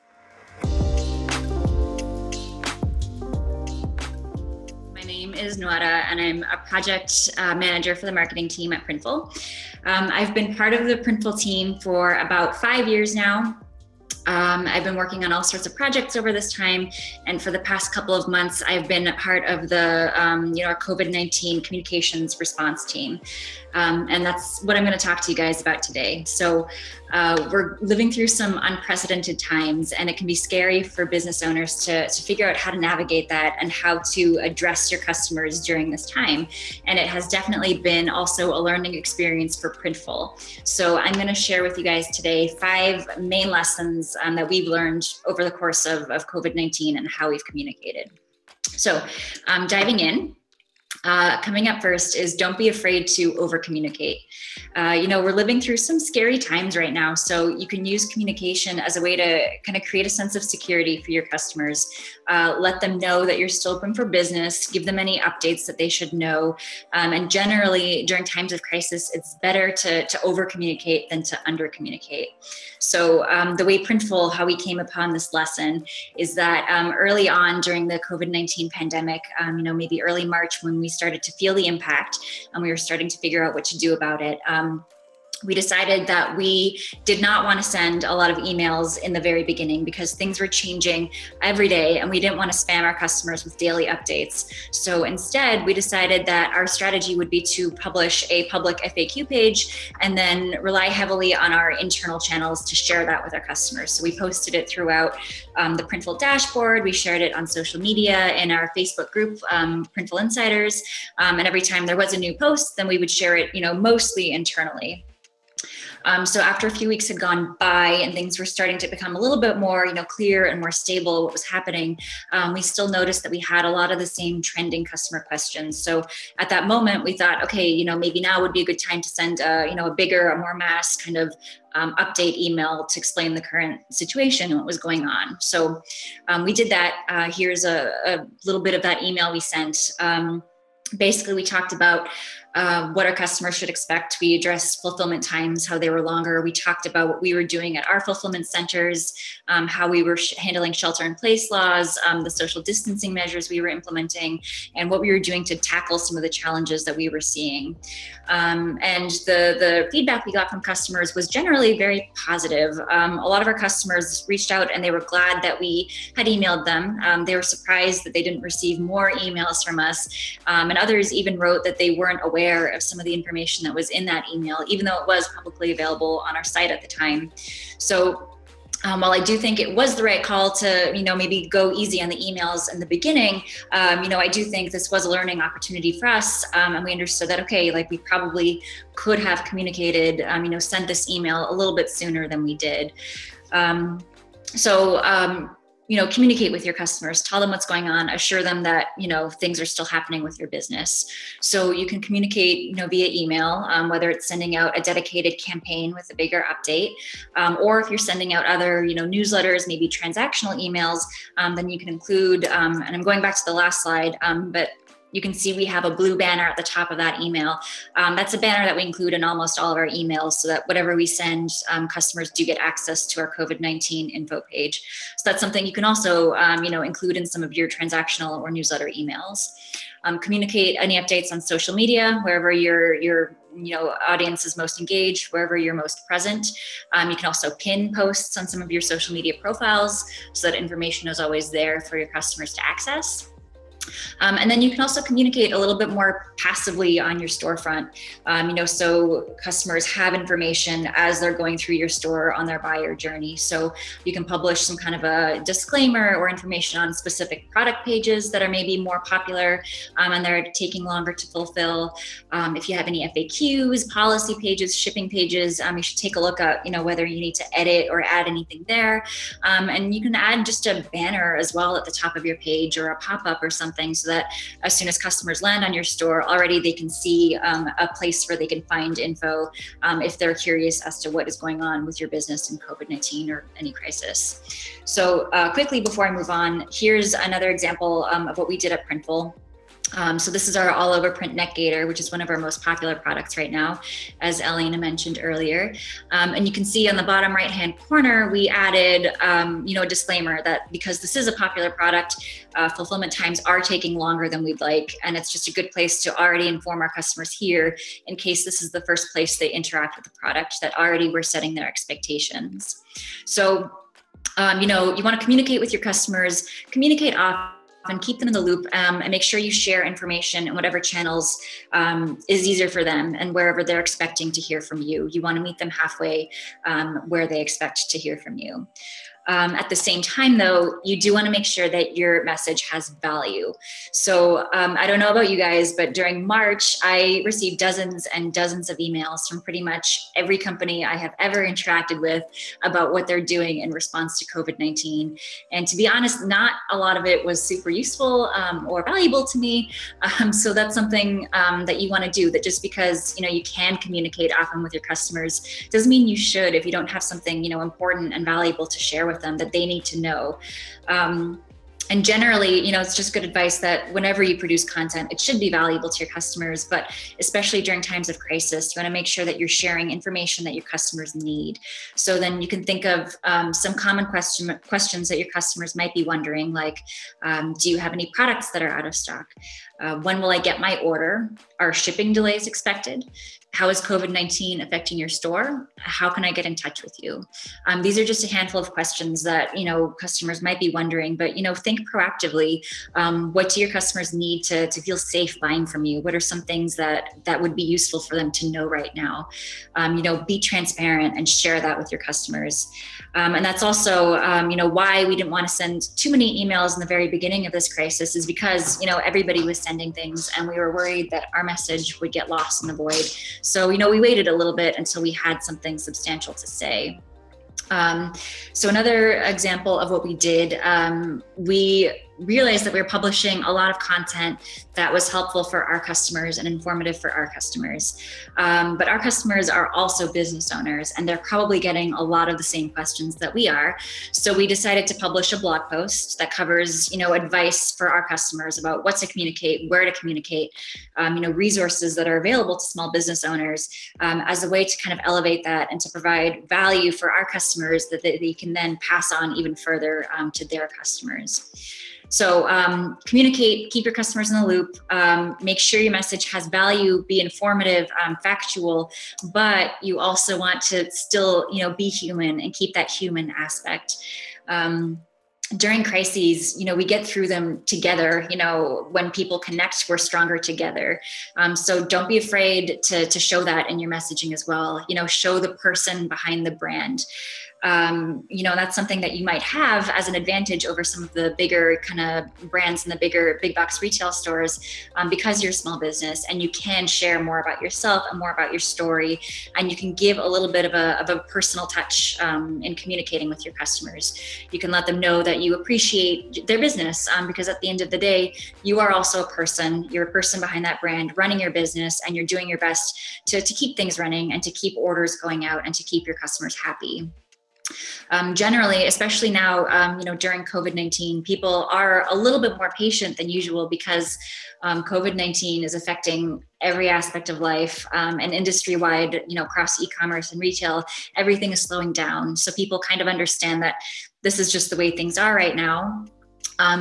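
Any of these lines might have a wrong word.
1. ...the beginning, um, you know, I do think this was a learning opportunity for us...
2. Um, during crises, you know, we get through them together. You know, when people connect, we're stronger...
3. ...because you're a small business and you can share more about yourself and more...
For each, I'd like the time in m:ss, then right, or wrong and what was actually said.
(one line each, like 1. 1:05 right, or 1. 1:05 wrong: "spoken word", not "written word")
1. 3:02 right
2. 7:44 right
3. 8:05 right.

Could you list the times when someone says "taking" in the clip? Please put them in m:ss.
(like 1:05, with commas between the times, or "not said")
4:20, 5:03.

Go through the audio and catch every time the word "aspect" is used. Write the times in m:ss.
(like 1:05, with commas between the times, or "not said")
7:43, 8:36.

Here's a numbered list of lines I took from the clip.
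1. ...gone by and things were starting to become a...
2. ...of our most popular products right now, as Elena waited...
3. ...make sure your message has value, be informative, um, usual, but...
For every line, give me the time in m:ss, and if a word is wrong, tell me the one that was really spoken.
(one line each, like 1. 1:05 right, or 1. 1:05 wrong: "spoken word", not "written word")
1. 1:57 right
2. 4:52 wrong: "mentioned", not "waited"
3. 7:35 wrong: "factual", not "usual".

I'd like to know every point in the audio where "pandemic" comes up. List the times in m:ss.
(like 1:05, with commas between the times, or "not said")
1:18.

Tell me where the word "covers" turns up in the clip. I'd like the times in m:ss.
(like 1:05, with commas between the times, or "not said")
7:16.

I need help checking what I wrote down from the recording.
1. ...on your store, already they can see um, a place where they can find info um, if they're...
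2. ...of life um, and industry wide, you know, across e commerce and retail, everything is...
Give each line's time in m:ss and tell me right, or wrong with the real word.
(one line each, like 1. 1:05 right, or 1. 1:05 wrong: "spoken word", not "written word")
1. 4:35 right
2. 8:37 right.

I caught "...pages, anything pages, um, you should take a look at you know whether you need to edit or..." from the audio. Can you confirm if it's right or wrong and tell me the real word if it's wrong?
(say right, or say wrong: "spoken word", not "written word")
wrong: "shipping", not "anything".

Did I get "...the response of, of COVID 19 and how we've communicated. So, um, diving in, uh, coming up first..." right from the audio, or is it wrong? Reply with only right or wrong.
wrong.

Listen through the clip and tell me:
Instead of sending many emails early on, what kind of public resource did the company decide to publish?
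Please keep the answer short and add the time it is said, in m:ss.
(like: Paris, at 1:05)
FAQ page, at 1:38.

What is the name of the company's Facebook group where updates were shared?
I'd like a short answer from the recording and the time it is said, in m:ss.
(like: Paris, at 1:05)
Printful Insiders, at 1:49.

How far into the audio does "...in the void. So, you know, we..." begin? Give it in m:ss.
6:52.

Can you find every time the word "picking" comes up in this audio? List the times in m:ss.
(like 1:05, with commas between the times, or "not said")
not said.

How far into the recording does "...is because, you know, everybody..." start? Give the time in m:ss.
6:48.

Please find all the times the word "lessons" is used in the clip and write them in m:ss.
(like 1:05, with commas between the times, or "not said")
0:43, 1:15.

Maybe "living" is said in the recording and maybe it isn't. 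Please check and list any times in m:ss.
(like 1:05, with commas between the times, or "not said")
0:27, 0:55.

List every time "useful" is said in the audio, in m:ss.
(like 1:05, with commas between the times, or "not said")
5:47, 6:37.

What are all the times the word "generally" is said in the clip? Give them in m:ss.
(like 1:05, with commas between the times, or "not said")
1:07, 2:41, 6:02, 8:28.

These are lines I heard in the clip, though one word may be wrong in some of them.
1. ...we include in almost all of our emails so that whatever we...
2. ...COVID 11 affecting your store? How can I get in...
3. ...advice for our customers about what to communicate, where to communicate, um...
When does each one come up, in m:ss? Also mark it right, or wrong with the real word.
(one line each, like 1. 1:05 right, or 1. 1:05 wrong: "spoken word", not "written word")
1. 3:38 right
2. 6:23 wrong: "19", not "11"
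3. 7:17 right.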